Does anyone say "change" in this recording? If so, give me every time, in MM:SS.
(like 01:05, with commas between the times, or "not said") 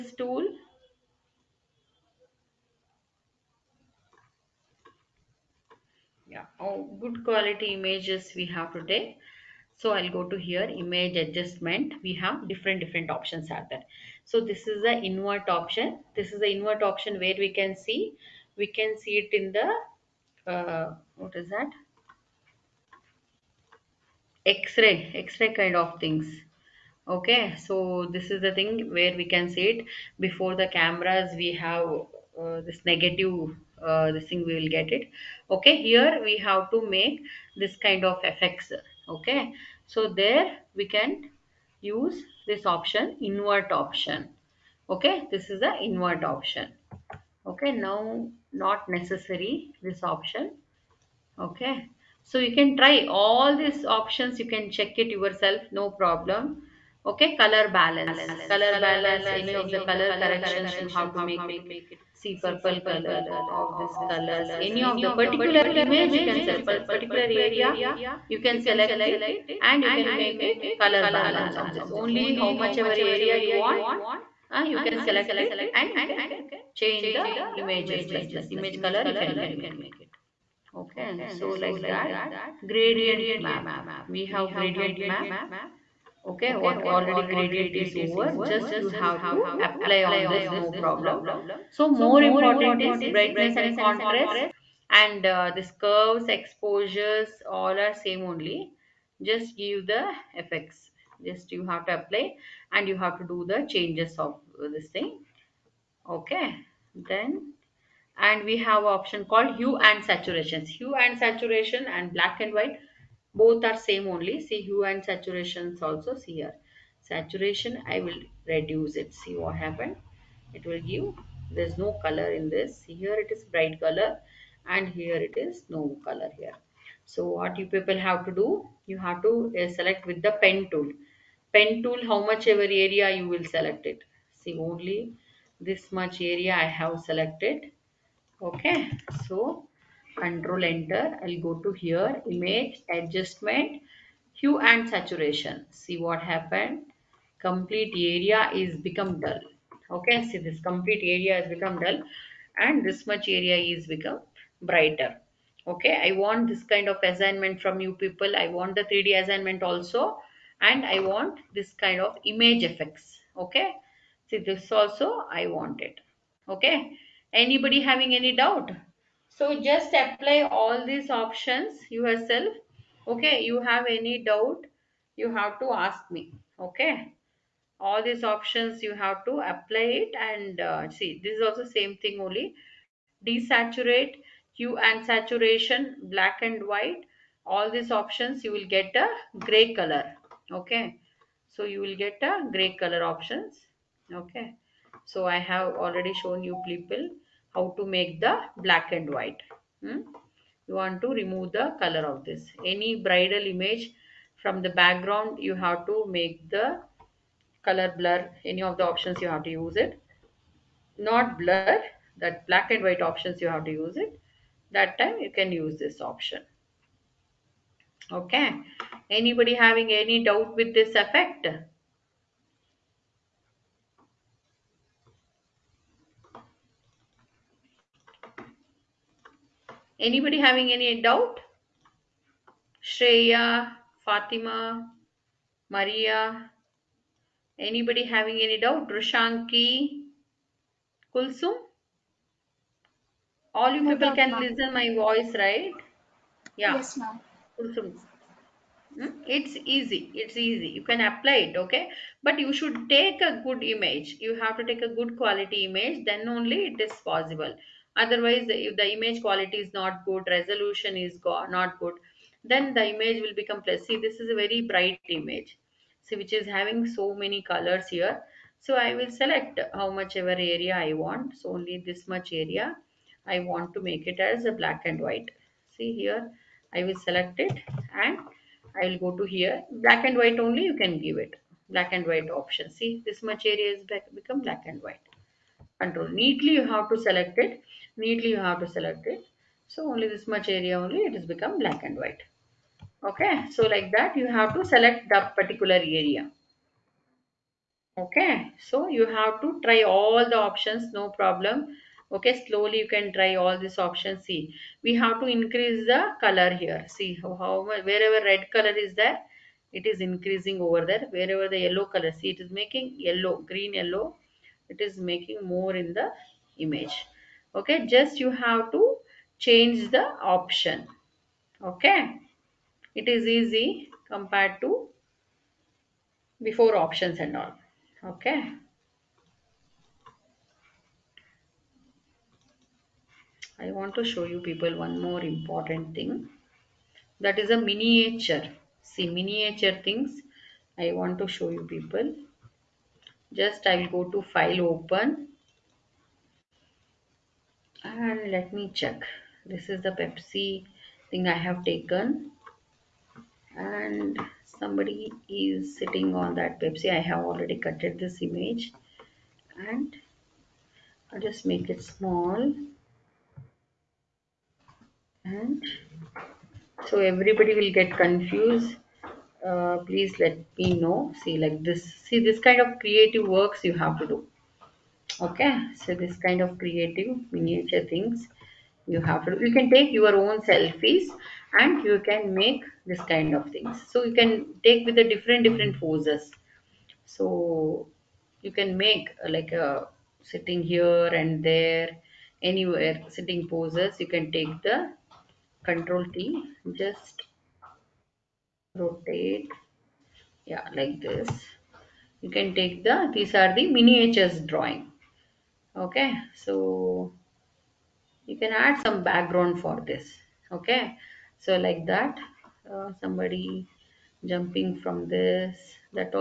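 01:16, 01:43, 05:19.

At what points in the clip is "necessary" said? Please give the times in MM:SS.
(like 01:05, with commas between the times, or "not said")
00:48.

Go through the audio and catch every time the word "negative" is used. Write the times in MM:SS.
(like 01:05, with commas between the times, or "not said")
00:32.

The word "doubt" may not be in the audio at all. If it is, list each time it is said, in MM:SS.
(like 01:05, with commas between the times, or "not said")
02:48, 02:54, 03:40, 03:51, 03:58.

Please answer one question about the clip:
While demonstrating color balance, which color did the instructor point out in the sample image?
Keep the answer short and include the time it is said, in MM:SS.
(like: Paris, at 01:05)
Purple, at 01:02.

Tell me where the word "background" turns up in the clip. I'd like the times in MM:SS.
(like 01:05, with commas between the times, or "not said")
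03:24, 06:49.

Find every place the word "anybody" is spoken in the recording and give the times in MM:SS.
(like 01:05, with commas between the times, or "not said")
02:47, 03:39, 03:49, 03:57.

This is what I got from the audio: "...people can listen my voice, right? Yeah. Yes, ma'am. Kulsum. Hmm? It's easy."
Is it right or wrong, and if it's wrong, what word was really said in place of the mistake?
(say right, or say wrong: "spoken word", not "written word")
right.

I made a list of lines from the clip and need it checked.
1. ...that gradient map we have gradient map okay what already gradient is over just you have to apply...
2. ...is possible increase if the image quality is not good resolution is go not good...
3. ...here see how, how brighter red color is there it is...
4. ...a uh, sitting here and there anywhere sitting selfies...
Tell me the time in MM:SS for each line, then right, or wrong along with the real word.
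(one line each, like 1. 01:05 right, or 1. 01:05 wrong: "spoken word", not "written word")
1. 01:21 right
2. 04:16 wrong: "otherwise", not "increase"
3. 05:06 wrong: "wherever", not "brighter"
4. 06:29 wrong: "poses", not "selfies".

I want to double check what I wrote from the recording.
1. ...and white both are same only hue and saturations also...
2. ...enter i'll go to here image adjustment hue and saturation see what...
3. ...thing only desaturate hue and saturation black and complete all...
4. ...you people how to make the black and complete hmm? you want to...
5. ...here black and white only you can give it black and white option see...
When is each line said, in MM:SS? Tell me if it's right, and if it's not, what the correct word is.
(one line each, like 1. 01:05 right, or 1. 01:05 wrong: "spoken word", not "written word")
1. 01:52 right
2. 02:20 right
3. 03:02 wrong: "white", not "complete"
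4. 03:16 wrong: "white", not "complete"
5. 04:39 right.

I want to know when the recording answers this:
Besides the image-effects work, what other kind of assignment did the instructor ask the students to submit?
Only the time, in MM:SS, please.
02:38.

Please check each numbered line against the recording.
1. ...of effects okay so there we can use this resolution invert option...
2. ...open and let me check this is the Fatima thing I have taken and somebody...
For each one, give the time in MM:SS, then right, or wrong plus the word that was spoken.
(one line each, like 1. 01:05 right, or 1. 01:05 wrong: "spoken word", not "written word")
1. 00:38 wrong: "option", not "resolution"
2. 05:44 wrong: "Pepsi", not "Fatima".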